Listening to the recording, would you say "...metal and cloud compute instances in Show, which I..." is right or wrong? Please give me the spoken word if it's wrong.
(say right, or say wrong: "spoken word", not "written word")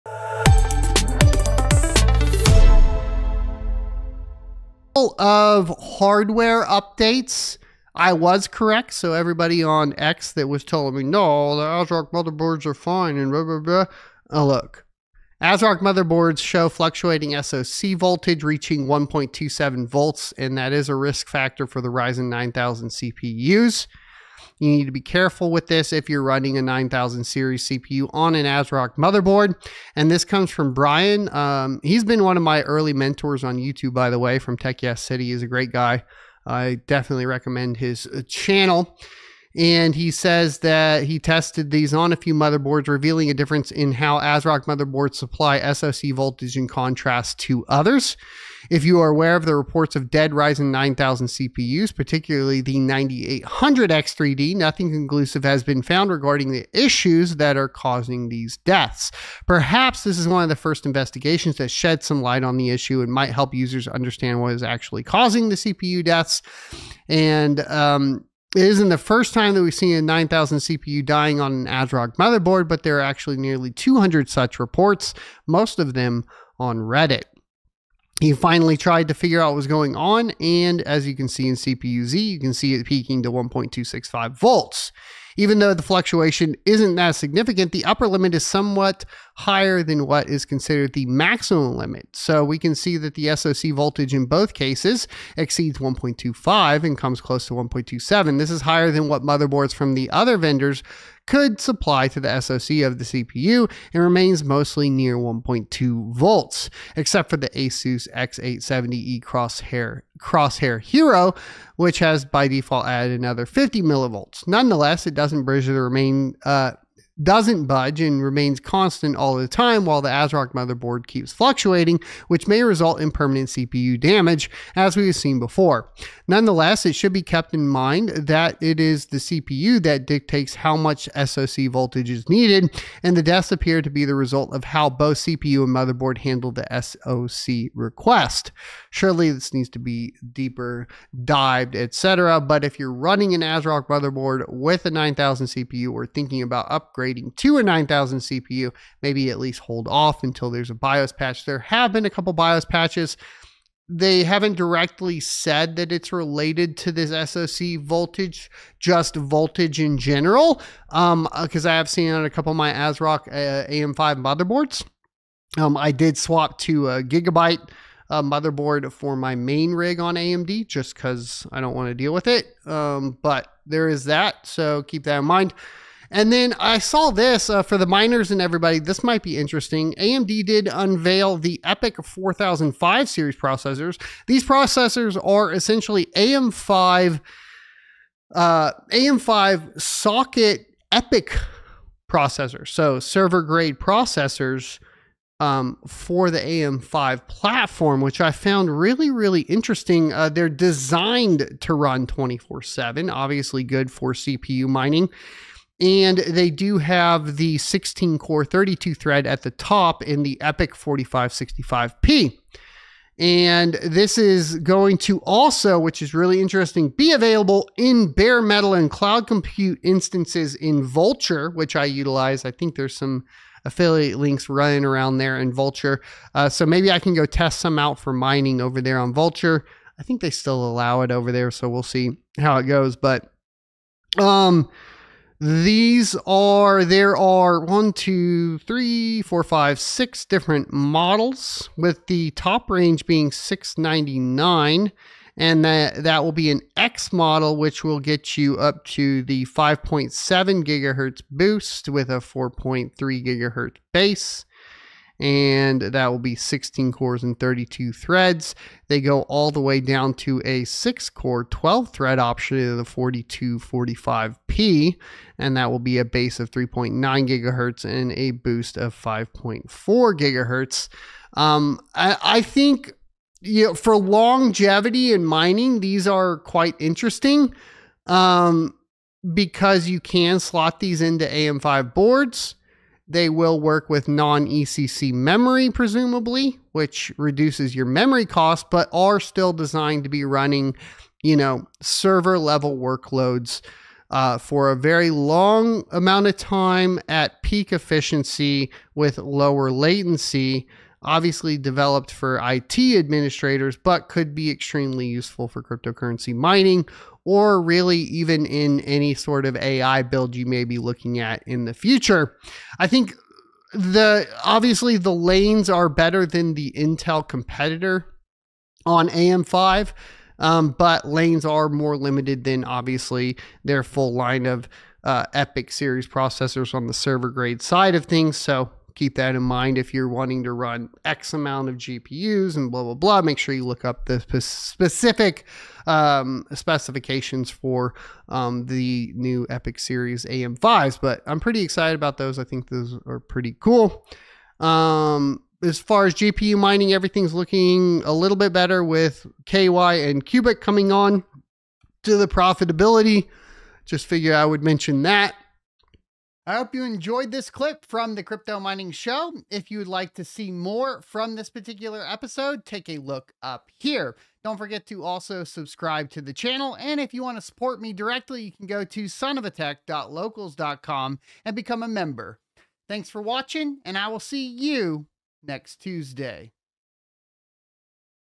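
wrong: "Vultr", not "Show".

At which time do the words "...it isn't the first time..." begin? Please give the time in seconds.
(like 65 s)
68 s.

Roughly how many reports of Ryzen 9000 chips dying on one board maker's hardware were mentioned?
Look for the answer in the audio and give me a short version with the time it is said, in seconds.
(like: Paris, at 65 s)
200, at 73 s.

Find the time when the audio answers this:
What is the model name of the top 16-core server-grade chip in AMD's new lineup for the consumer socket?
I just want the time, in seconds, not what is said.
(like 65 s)
210 s.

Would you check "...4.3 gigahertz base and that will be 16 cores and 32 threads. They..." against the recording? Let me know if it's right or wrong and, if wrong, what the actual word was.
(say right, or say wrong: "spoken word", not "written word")
right.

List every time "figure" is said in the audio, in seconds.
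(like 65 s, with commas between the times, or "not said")
79 s, 354 s.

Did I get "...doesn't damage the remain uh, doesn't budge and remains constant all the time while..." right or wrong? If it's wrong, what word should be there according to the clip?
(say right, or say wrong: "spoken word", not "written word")
wrong: "bridge", not "damage".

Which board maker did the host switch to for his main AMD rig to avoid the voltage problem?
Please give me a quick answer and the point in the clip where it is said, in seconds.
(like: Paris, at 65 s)
Gigabyte, at 167 s.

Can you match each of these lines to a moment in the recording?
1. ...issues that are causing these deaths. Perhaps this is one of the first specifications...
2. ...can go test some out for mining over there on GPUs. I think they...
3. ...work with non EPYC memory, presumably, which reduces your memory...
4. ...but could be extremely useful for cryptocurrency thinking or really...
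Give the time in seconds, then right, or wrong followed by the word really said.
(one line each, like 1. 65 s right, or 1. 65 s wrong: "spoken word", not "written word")
1. 56 s wrong: "investigations", not "specifications"
2. 226 s wrong: "Vultr", not "GPUs"
3. 283 s wrong: "ECC", not "EPYC"
4. 303 s wrong: "mining", not "thinking".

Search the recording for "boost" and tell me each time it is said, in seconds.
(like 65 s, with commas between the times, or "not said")
251 s, 268 s.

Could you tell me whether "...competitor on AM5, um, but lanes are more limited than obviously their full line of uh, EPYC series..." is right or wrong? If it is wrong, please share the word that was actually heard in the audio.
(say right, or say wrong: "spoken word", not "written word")
right.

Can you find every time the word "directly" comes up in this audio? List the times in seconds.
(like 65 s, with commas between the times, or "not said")
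154 s, 367 s.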